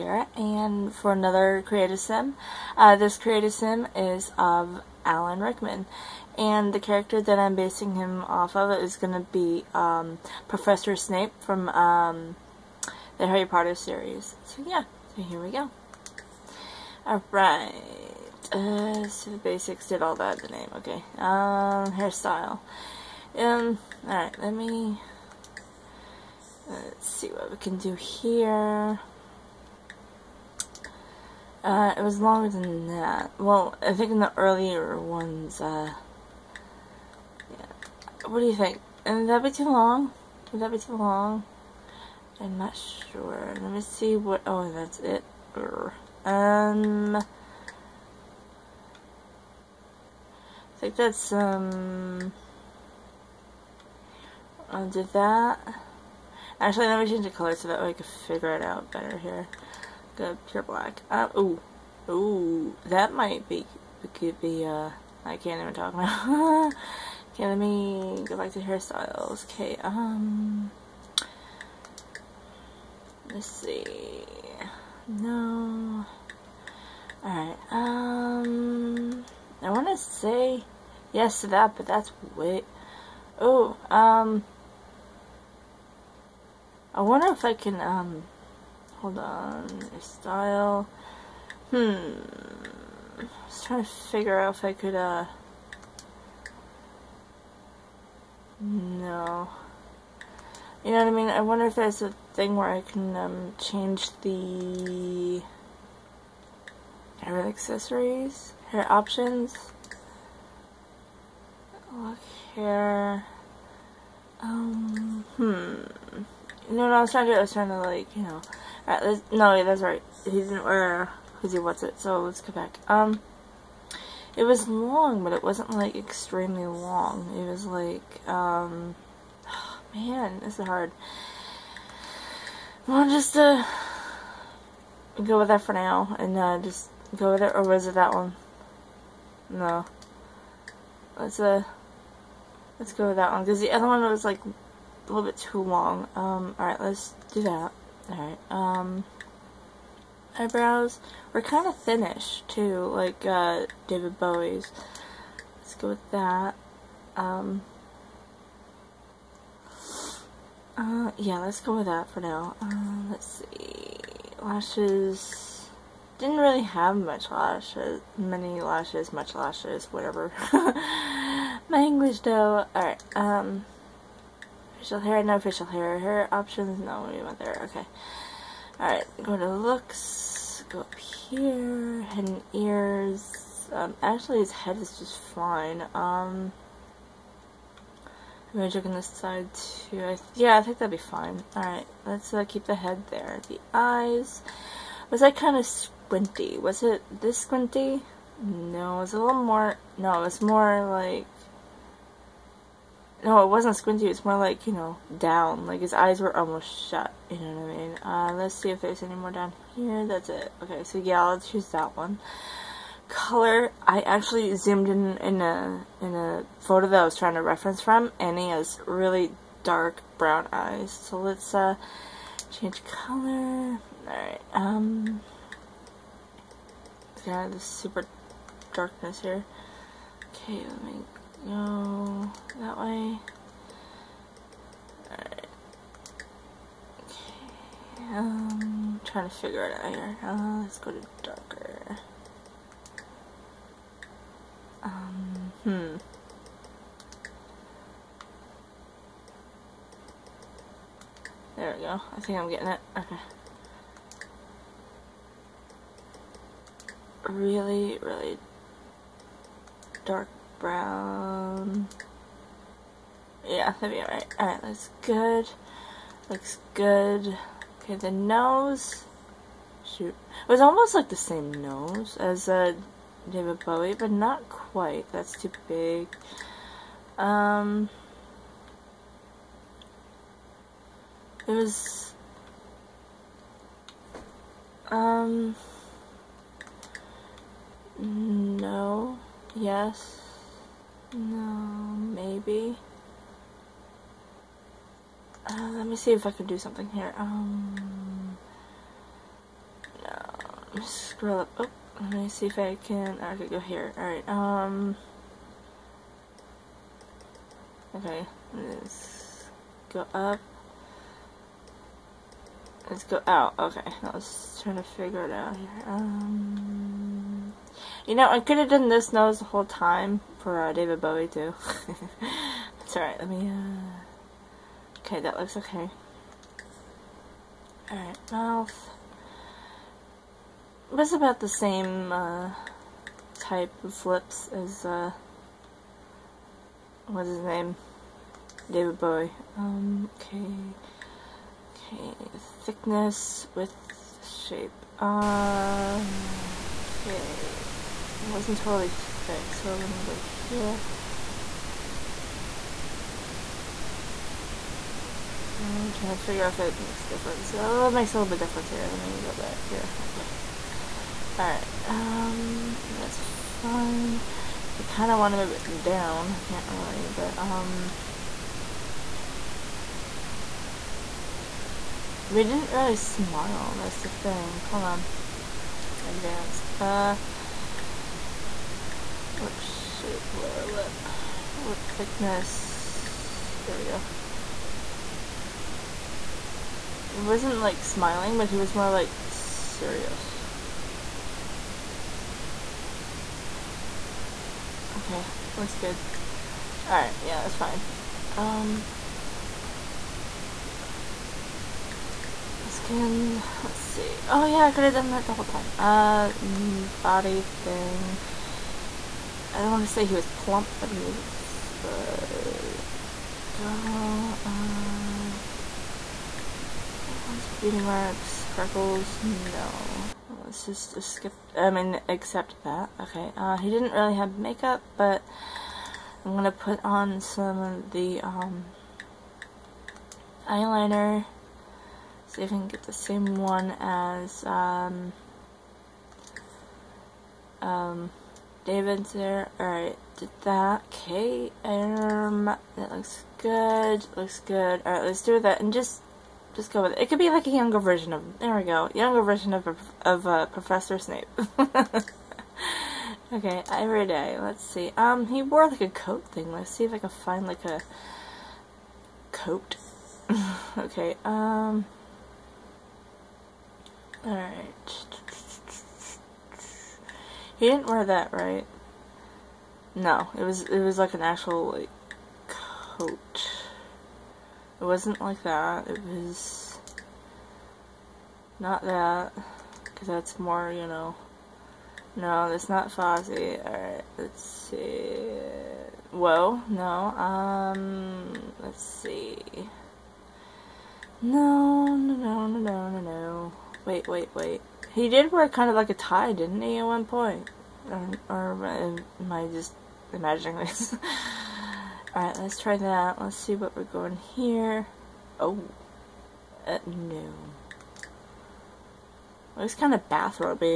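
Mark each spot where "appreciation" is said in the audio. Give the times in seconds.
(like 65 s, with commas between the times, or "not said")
not said.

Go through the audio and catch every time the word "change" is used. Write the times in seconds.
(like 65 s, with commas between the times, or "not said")
57 s, 103 s, 222 s.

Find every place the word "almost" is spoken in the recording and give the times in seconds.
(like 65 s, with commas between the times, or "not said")
206 s, 270 s.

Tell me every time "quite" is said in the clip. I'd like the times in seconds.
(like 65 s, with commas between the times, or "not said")
274 s.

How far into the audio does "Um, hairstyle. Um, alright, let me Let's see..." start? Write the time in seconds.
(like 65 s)
21 s.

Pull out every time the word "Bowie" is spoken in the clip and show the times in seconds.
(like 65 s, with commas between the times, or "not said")
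154 s, 273 s, 321 s, 339 s.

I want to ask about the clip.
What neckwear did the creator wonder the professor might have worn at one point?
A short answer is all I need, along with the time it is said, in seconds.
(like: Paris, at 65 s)
A tie, at 495 s.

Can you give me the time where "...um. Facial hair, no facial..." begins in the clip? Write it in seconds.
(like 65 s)
173 s.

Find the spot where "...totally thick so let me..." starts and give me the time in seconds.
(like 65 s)
348 s.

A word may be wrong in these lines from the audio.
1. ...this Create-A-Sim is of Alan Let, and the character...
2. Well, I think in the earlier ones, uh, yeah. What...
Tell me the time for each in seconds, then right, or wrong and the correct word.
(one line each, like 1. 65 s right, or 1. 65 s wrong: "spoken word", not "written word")
1. 2 s wrong: "Rickman", not "Let"
2. 33 s right.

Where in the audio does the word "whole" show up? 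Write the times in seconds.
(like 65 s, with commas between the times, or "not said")
319 s, 405 s.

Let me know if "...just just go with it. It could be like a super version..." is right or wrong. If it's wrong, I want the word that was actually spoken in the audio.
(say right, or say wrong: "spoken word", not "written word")
wrong: "younger", not "super".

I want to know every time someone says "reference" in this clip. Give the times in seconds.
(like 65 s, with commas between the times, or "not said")
217 s.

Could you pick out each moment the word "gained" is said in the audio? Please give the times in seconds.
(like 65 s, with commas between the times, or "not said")
not said.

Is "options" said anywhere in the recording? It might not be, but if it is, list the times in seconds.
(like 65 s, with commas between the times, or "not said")
108 s, 176 s.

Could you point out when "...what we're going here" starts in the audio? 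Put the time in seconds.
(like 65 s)
503 s.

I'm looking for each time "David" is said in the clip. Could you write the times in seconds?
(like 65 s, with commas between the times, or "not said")
153 s, 273 s, 320 s, 338 s, 438 s.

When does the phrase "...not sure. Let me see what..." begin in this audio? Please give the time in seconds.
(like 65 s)
42 s.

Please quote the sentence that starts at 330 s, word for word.
It was about the same, uh, type of lips as, uh...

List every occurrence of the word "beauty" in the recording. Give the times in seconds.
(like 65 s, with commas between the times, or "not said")
417 s.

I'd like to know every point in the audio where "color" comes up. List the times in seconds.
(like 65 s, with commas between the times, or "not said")
57 s, 213 s, 222 s.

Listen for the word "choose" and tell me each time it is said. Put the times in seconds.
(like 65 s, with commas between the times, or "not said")
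211 s.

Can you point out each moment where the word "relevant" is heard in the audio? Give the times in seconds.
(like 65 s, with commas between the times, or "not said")
not said.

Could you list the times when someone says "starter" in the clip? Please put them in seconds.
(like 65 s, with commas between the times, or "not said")
not said.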